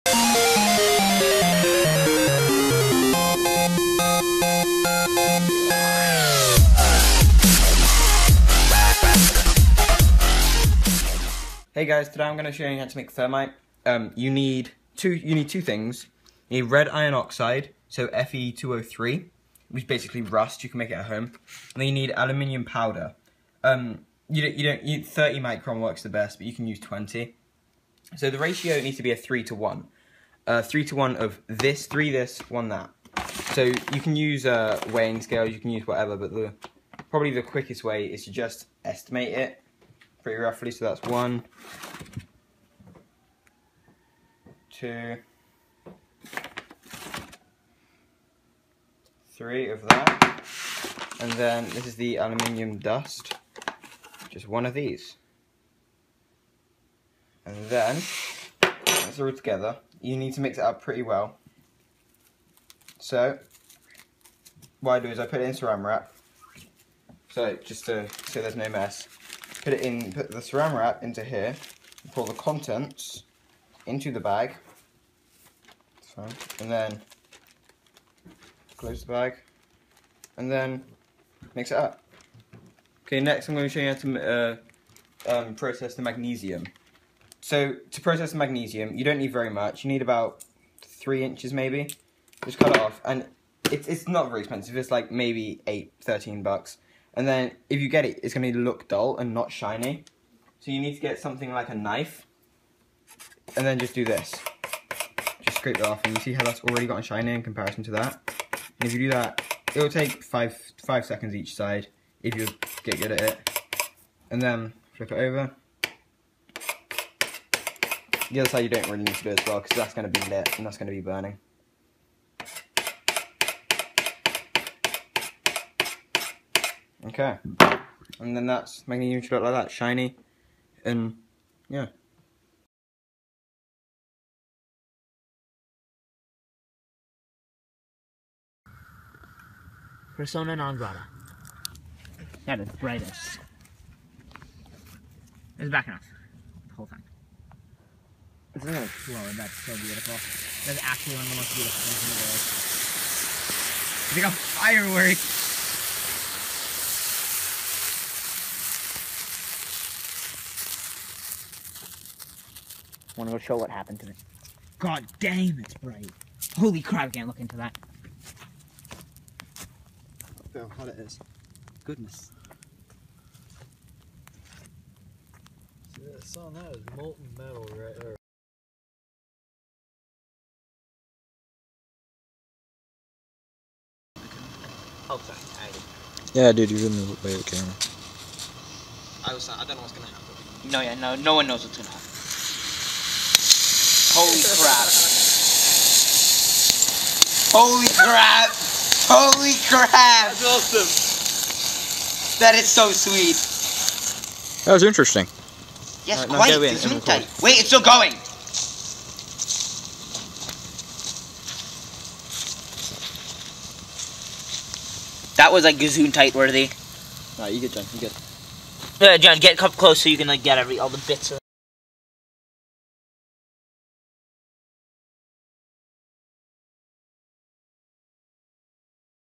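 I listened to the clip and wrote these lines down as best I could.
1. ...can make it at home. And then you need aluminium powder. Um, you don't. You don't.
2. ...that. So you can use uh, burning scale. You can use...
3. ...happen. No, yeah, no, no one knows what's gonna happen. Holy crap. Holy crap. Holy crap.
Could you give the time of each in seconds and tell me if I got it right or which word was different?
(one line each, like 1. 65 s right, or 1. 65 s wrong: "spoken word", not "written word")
1. 20 s right
2. 32 s wrong: "weighing", not "burning"
3. 190 s right.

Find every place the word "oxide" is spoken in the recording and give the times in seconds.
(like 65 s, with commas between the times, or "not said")
17 s.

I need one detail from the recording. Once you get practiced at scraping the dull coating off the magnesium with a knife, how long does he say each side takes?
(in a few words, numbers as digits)
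5 seconds.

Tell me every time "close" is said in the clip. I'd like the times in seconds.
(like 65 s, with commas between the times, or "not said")
78 s, 219 s.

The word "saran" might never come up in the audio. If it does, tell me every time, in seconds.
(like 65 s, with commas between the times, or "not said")
65 s, 70 s.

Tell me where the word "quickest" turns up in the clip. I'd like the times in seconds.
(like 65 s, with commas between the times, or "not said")
37 s.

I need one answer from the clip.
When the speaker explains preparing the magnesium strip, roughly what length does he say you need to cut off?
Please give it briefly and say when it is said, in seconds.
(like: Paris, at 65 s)
3 inches, at 90 s.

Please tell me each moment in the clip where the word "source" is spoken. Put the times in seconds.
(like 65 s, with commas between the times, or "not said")
not said.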